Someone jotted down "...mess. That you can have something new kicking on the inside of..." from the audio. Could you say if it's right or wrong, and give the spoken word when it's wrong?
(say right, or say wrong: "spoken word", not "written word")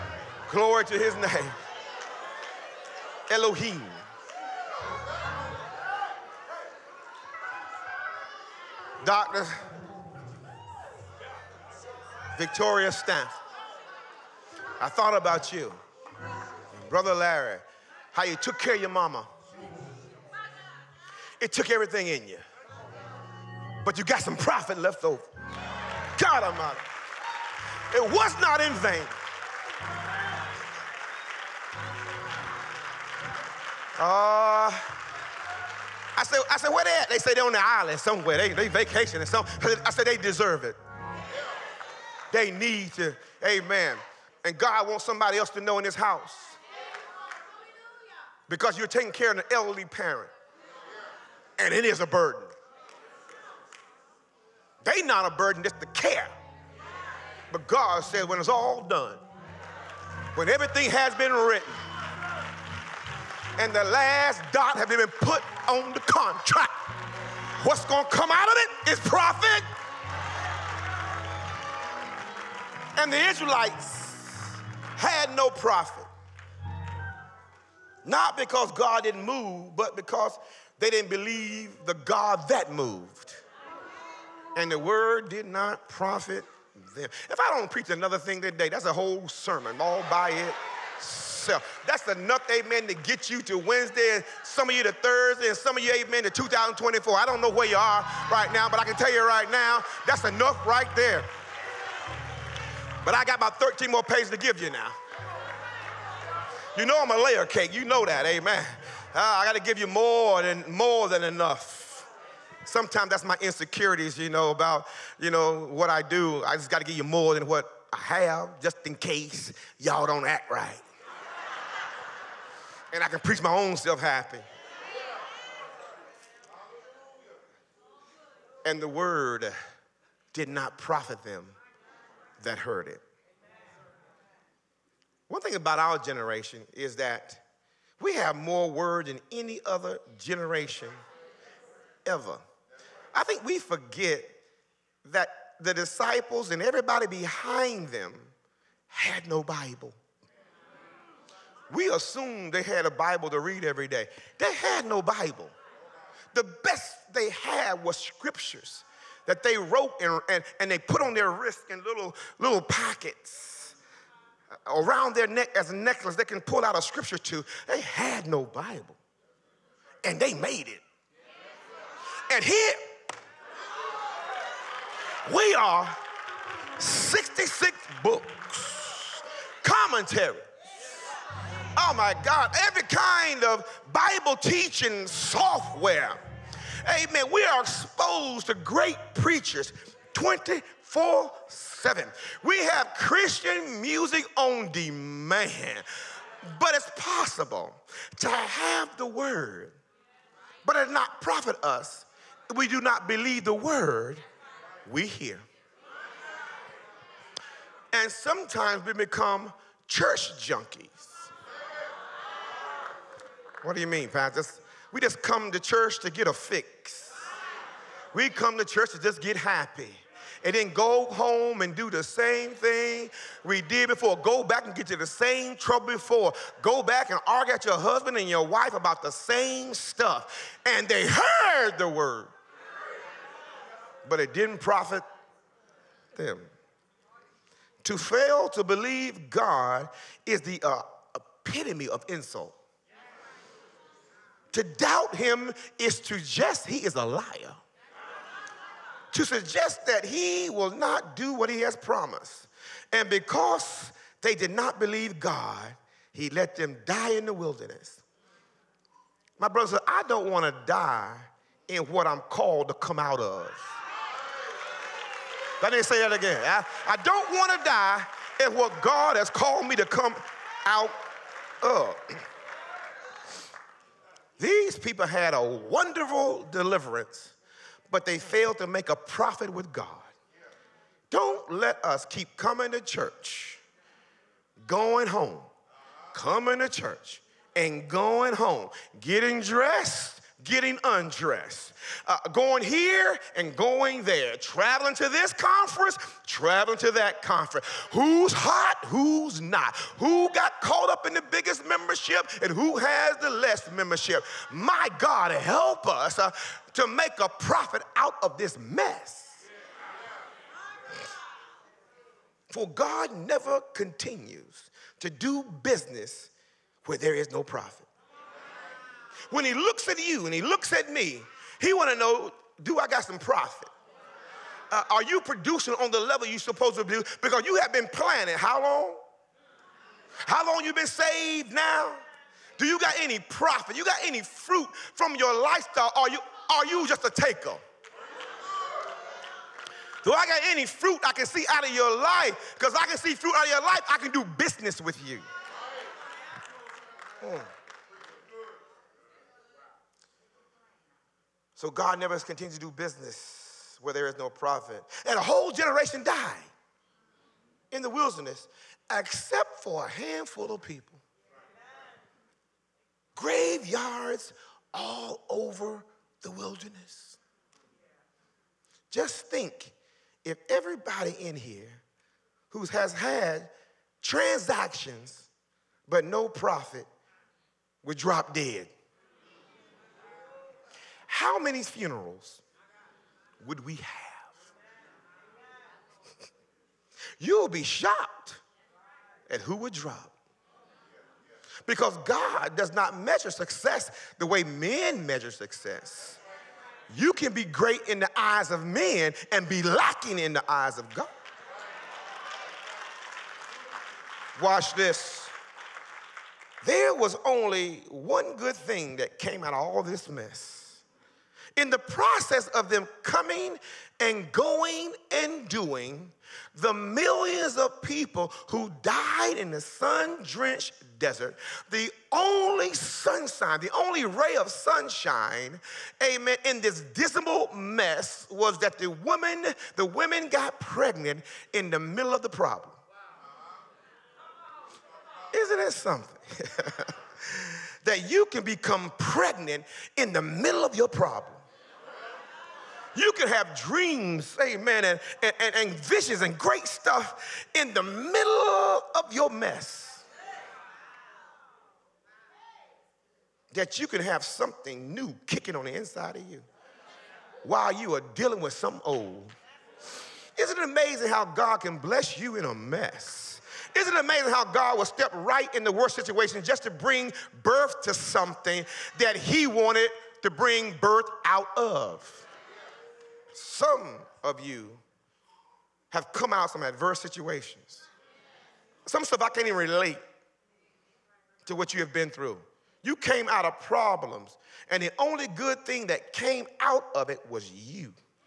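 right.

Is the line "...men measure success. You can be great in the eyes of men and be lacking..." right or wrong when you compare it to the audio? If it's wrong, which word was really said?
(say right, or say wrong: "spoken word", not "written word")
right.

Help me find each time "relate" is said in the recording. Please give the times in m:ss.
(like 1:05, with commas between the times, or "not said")
7:59.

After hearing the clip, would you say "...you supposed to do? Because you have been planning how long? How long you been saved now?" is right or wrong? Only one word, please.
right.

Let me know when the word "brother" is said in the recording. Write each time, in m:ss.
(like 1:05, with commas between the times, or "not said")
0:16, 4:19.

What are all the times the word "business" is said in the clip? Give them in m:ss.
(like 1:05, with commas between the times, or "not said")
5:15, 5:44, 5:52.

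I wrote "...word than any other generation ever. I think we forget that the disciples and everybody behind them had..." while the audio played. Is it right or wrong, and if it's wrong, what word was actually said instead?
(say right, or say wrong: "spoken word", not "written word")
right.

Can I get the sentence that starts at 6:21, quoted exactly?
How many funerals would we have?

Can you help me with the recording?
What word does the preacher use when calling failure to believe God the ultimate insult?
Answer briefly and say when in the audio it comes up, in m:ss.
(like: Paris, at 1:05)
epitome, at 4:01.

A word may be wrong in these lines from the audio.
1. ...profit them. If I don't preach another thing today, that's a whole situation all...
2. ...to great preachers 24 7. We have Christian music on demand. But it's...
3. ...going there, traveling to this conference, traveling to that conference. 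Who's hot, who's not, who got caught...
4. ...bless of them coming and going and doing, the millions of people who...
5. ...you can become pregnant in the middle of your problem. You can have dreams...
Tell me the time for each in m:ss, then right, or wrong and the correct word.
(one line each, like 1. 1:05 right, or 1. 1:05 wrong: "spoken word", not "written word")
1. 1:25 wrong: "sermon", not "situation"
2. 3:08 right
3. 4:53 right
4. 6:51 wrong: "process", not "bless"
5. 7:18 right.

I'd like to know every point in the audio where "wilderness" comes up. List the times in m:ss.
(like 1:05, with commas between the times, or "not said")
4:17, 5:57, 6:06.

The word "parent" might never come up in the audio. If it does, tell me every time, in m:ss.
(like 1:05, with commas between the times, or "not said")
0:49.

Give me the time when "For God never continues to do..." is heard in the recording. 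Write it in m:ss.
5:12.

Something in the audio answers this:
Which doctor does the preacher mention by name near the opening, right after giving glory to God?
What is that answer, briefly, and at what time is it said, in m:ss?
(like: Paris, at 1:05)
Dr. Victoria Staff, at 0:09.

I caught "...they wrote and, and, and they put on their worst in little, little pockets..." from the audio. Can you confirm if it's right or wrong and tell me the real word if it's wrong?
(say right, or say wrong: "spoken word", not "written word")
wrong: "wrist", not "worst".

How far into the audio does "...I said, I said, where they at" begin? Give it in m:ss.
0:36.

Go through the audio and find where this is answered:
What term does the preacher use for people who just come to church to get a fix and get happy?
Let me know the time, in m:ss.
3:29.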